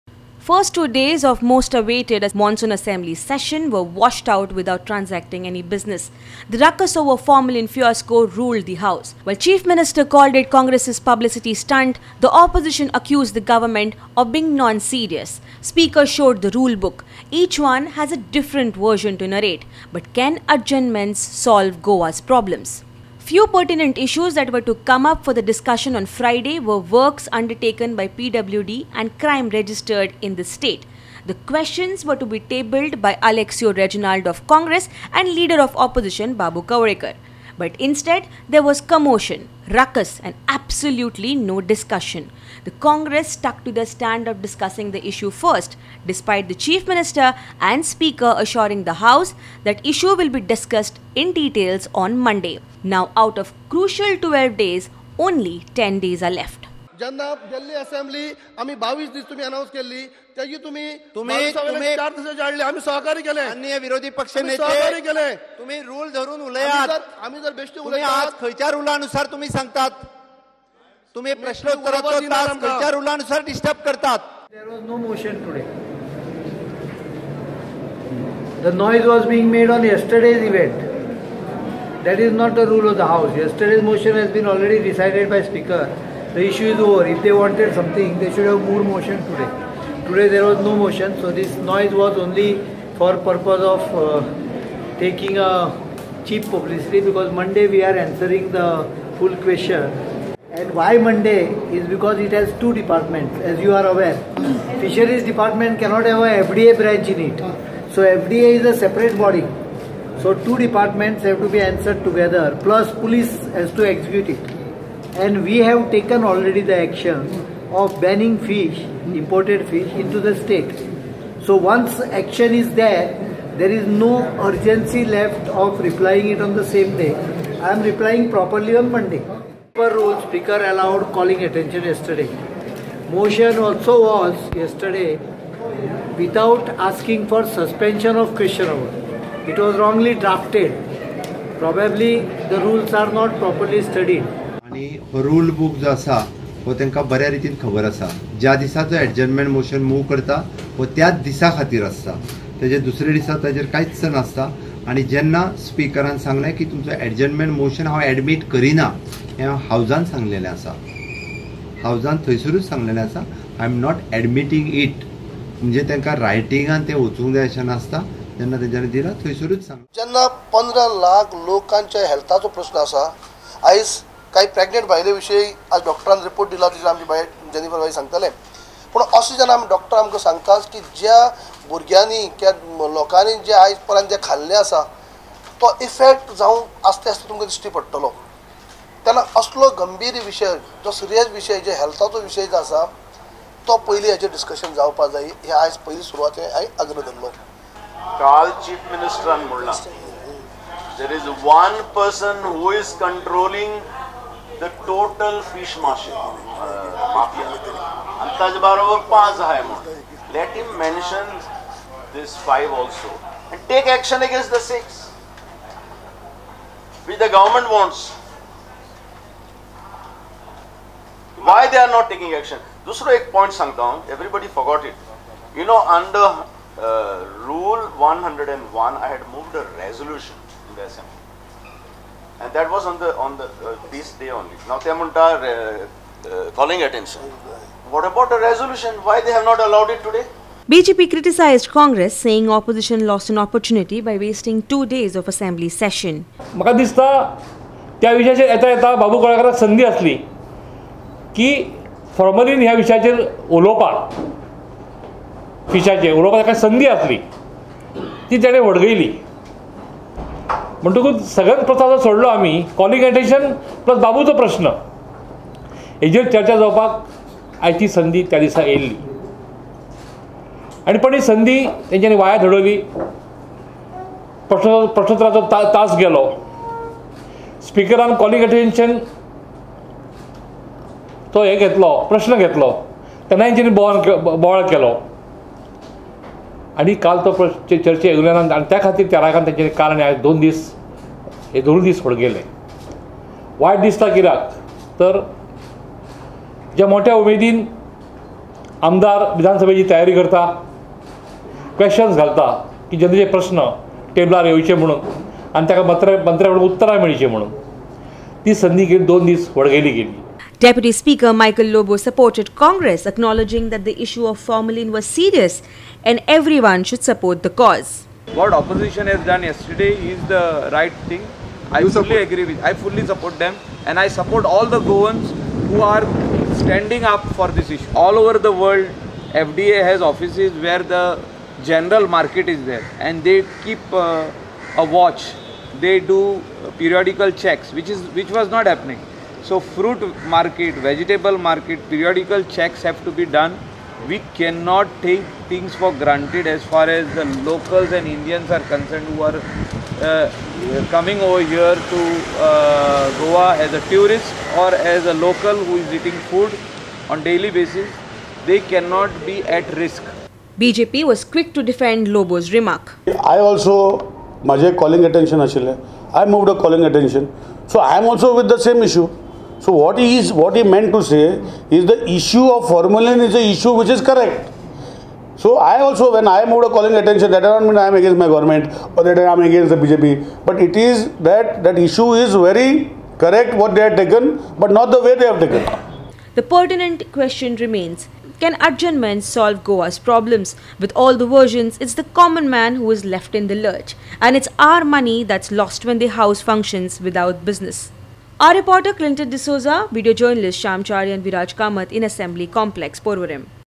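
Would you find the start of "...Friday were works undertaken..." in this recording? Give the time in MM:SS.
00:26.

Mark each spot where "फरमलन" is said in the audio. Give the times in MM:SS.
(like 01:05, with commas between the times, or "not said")
04:12.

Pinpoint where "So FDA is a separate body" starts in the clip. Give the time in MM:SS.
01:47.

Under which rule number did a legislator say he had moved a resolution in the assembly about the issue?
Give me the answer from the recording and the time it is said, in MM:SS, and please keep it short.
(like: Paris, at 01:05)
Rule 101, at 03:47.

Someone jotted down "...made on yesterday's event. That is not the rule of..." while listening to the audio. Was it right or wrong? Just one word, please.
right.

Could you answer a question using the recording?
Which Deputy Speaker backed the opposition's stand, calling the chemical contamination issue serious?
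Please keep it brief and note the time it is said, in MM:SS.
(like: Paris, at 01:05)
Michael Lobo, at 05:11.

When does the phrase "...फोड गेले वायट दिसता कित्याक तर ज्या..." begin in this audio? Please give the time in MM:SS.
04:52.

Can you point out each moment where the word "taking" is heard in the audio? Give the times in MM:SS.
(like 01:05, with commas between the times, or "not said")
01:34, 03:42.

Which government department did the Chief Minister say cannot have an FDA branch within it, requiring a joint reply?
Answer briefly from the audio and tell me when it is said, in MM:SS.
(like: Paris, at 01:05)
Fisheries department, at 01:44.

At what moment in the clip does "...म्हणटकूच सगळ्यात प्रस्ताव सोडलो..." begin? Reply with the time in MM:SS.
04:20.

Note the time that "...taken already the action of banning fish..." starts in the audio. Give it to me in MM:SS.
01:55.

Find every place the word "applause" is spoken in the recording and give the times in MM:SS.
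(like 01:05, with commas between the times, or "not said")
not said.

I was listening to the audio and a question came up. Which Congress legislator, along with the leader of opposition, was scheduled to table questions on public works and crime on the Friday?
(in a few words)
Aleixo Reginald.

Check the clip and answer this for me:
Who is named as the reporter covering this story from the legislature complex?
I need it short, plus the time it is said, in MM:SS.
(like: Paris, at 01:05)
Clinton D'Souza, at 06:38.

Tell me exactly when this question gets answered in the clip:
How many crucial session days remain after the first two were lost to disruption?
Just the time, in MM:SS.
00:55.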